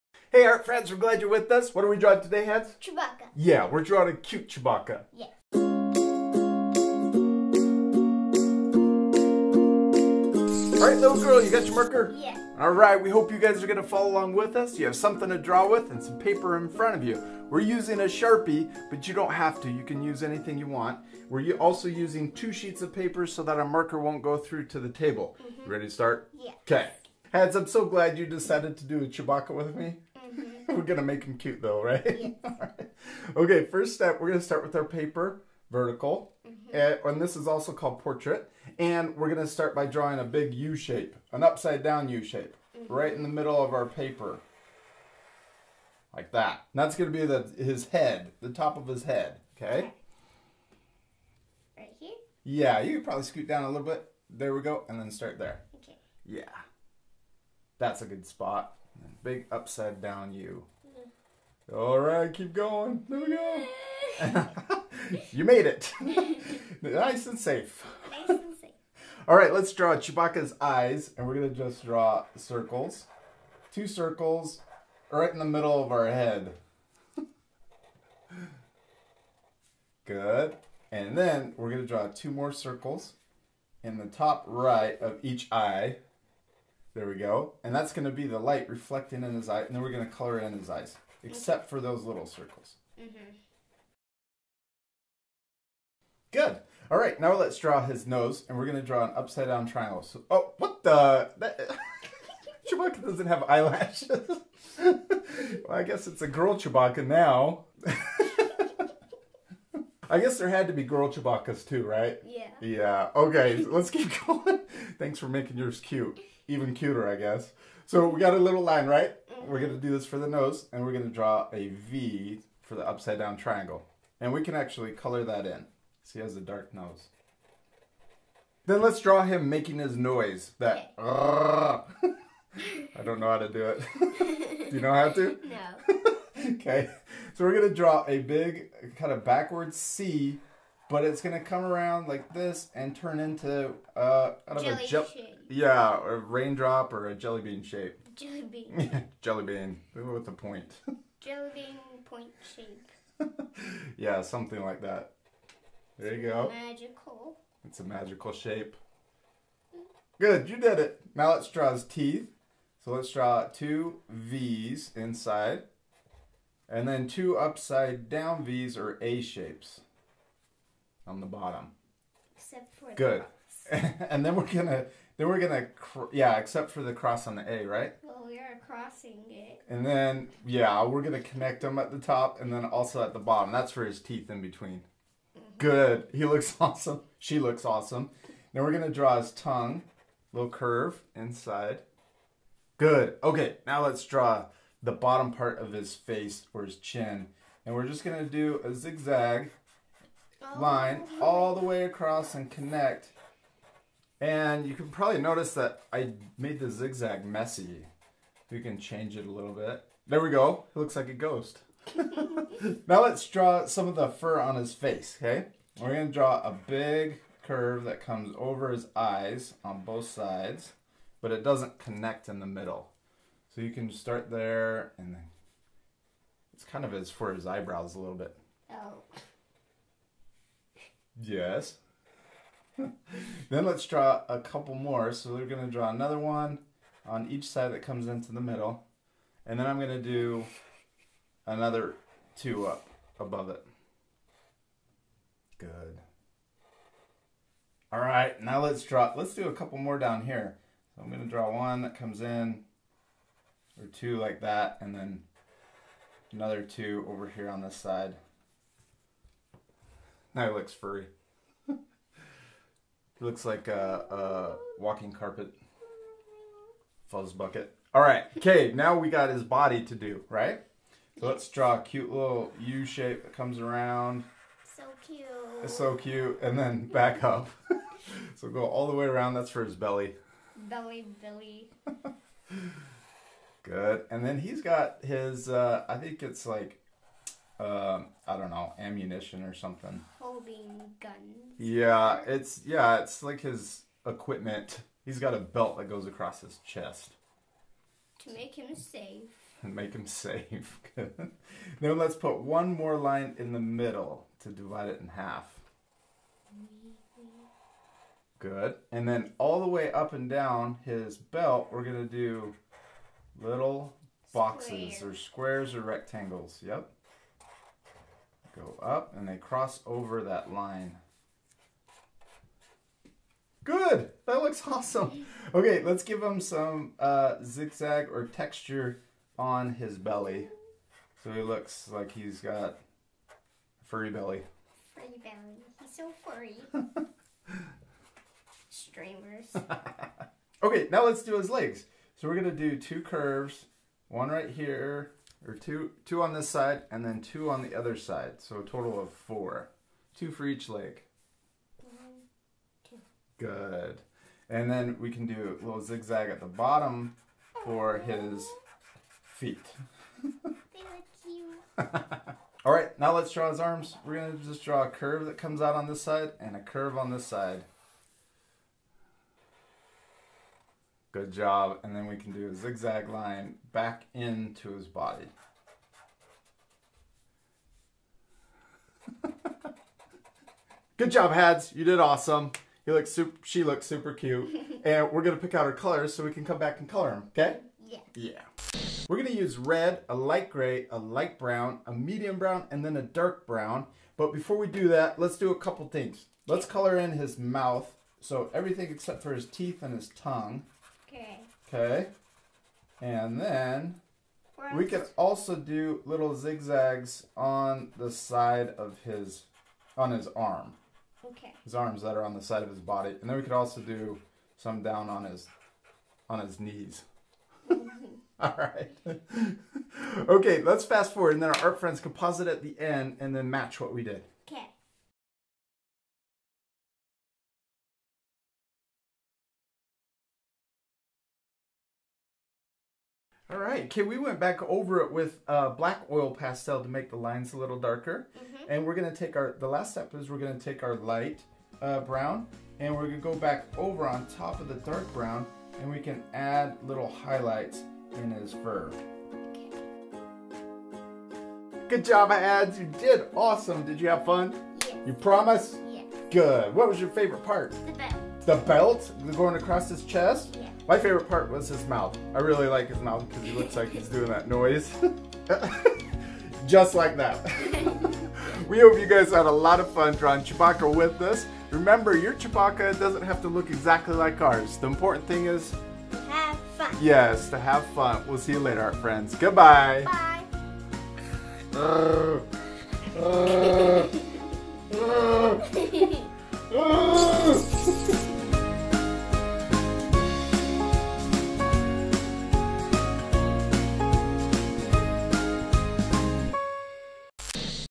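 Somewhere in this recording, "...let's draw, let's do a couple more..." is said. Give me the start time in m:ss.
4:08.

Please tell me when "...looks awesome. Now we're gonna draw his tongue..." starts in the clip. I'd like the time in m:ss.
3:07.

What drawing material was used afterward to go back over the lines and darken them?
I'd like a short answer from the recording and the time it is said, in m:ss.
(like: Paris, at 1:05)
black oil pastel, at 7:15.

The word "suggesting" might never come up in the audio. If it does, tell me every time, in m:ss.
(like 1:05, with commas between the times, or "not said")
not said.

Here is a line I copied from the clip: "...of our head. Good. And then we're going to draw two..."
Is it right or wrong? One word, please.
right.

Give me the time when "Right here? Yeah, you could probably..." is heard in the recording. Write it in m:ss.
0:51.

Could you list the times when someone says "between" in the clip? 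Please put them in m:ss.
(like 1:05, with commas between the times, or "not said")
3:04.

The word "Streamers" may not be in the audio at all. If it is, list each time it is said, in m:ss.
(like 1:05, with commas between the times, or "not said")
5:38.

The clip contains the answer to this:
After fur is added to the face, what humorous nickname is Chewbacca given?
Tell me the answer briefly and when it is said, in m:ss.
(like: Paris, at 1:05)
walking carpet fuzz bucket, at 4:24.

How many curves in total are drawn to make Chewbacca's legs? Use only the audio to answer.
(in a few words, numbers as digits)
4.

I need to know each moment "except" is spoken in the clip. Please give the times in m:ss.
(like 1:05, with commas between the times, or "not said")
1:31, 2:52, 2:56, 6:38.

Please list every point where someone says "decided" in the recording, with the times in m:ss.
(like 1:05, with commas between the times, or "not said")
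0:28.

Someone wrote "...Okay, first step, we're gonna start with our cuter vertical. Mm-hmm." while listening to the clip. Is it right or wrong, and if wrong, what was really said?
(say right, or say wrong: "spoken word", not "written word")
wrong: "paper", not "cuter".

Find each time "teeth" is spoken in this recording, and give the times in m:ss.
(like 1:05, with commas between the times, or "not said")
2:41, 3:04, 6:39.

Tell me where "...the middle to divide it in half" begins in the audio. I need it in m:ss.
5:03.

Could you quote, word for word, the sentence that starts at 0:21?
We're also using two sheets of paper so that our marker won't go through to the table.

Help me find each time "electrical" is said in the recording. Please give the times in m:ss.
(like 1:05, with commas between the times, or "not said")
not said.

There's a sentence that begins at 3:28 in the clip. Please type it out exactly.
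We can change it a little bit.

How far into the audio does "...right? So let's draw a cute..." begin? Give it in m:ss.
4:30.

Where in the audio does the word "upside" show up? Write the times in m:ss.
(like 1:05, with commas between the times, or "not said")
0:41, 0:59, 1:39, 2:02, 2:47.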